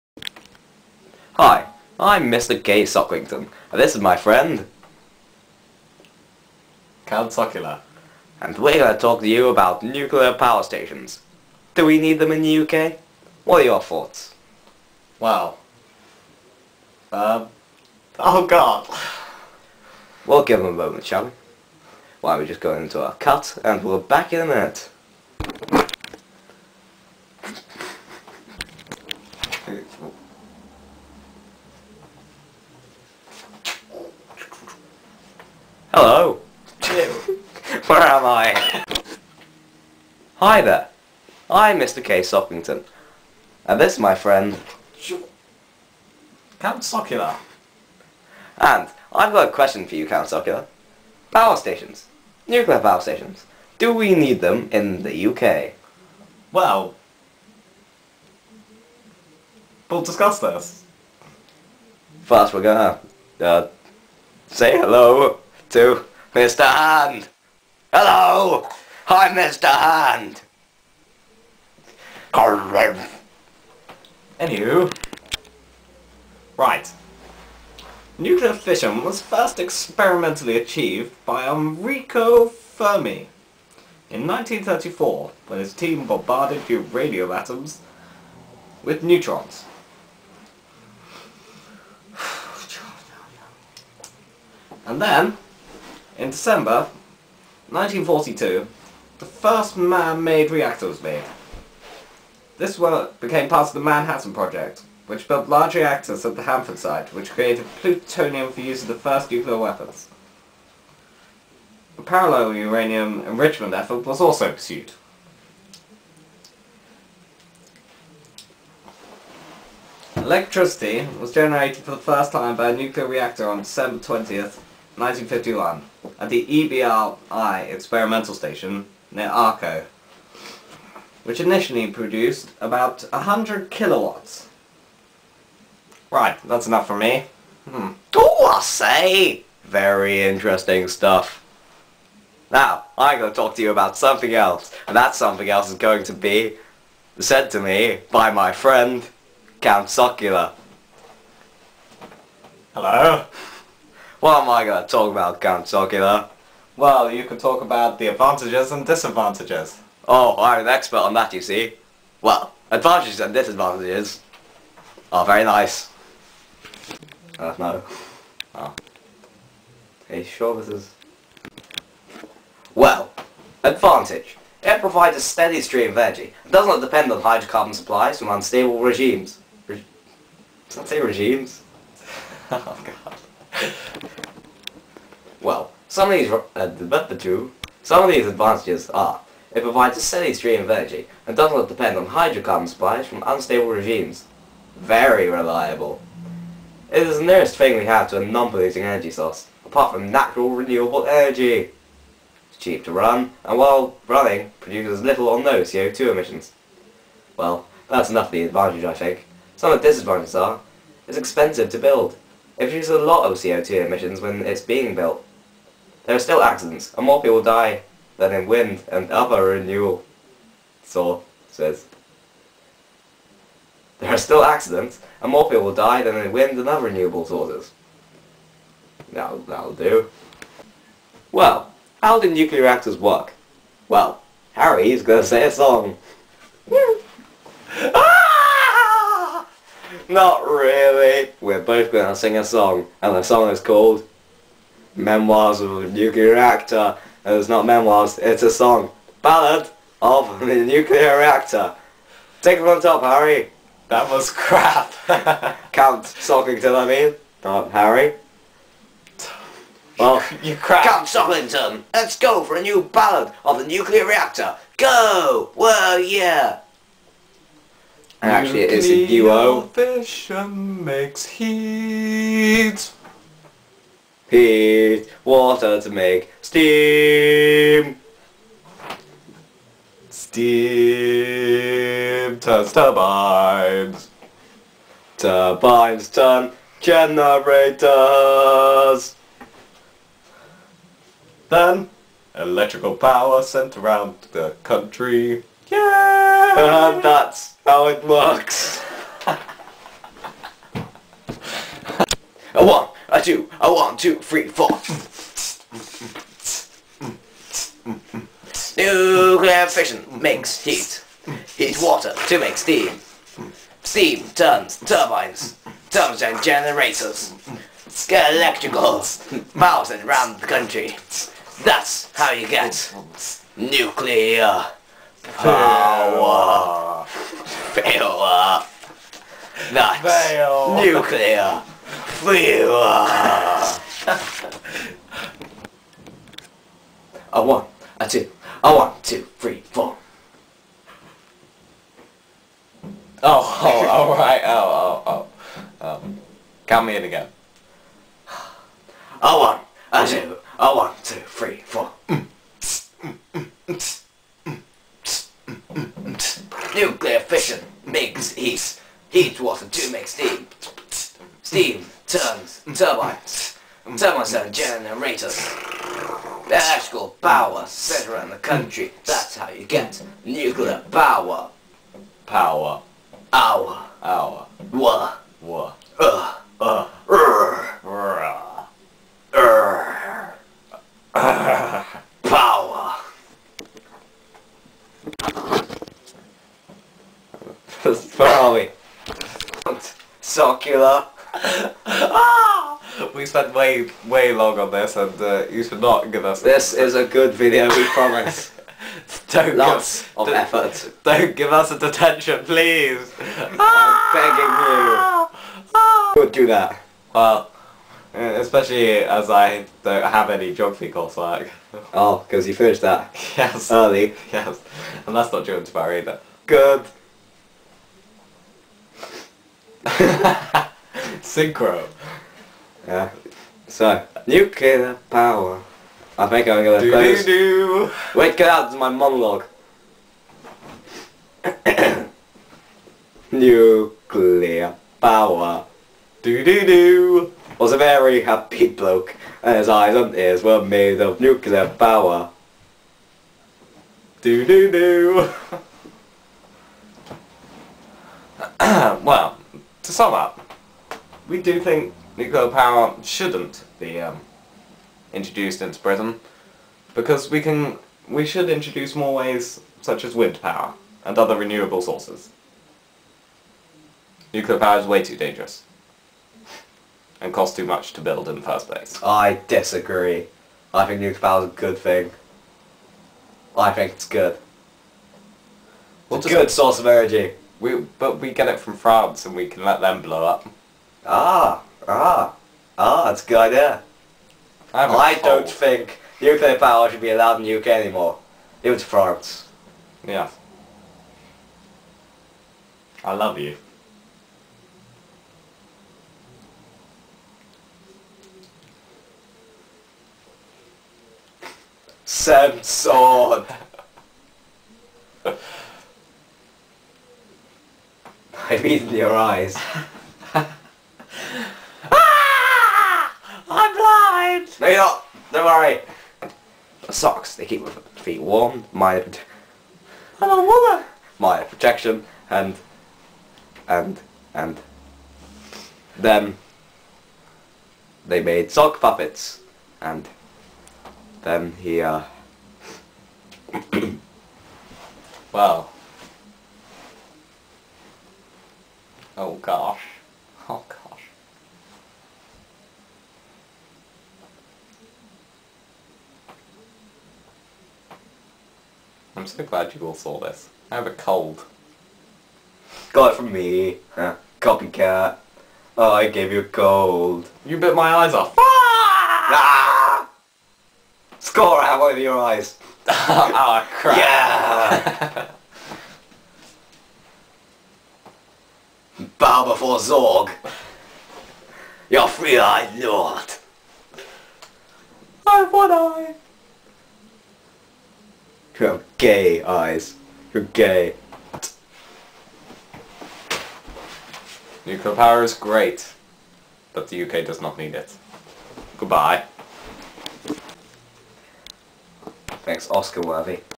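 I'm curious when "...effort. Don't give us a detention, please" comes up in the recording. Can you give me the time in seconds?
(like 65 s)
400 s.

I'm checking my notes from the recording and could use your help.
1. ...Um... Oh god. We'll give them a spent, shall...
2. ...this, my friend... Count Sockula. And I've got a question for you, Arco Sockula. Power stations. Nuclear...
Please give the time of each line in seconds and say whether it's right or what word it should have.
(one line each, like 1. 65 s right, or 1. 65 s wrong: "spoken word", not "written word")
1. 17 s wrong: "moment", not "spent"
2. 43 s wrong: "Count", not "Arco".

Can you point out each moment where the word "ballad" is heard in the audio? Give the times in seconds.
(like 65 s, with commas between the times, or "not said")
249 s, 262 s.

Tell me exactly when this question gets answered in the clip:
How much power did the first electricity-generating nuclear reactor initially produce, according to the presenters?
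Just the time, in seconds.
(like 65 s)
133 s.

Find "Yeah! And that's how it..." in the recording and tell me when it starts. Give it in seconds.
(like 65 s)
295 s.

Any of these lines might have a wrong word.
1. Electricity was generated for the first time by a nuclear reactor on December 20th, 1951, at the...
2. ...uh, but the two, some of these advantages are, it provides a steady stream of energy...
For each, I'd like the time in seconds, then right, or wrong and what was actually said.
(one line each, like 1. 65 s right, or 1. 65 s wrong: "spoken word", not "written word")
1. 120 s right
2. 186 s right.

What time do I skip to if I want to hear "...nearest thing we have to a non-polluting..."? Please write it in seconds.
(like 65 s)
197 s.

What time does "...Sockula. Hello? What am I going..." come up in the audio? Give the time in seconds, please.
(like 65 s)
149 s.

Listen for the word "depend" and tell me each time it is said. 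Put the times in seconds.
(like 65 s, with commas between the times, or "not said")
176 s, 191 s.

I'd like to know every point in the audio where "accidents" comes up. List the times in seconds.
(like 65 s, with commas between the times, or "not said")
216 s, 224 s.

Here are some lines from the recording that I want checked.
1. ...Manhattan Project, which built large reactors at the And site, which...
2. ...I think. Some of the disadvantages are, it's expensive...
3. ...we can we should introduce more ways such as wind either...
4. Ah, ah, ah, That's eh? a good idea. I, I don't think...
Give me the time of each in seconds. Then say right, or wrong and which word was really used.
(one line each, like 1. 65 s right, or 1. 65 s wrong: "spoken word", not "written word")
1. 103 s wrong: "Hanford", not "And"
2. 208 s right
3. 457 s wrong: "power", not "either"
4. 481 s right.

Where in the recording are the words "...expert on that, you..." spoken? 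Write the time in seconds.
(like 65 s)
160 s.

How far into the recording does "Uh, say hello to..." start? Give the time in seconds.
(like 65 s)
63 s.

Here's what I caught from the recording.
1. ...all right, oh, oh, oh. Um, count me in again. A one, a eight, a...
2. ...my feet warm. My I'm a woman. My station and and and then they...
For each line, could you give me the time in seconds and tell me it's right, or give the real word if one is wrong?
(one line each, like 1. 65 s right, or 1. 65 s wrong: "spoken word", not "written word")
1. 343 s wrong: "two", not "eight"
2. 517 s wrong: "protection", not "station".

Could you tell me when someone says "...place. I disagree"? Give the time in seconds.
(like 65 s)
468 s.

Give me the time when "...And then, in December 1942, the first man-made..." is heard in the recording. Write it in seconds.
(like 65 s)
94 s.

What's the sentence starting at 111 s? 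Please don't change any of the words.
A parallel uranium enrichment effort was also pursued.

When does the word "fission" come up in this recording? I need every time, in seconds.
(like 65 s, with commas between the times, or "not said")
78 s, 269 s, 309 s, 357 s.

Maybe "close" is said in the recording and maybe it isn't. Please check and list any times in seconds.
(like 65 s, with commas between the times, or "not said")
426 s.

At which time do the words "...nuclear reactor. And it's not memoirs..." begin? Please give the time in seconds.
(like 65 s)
245 s.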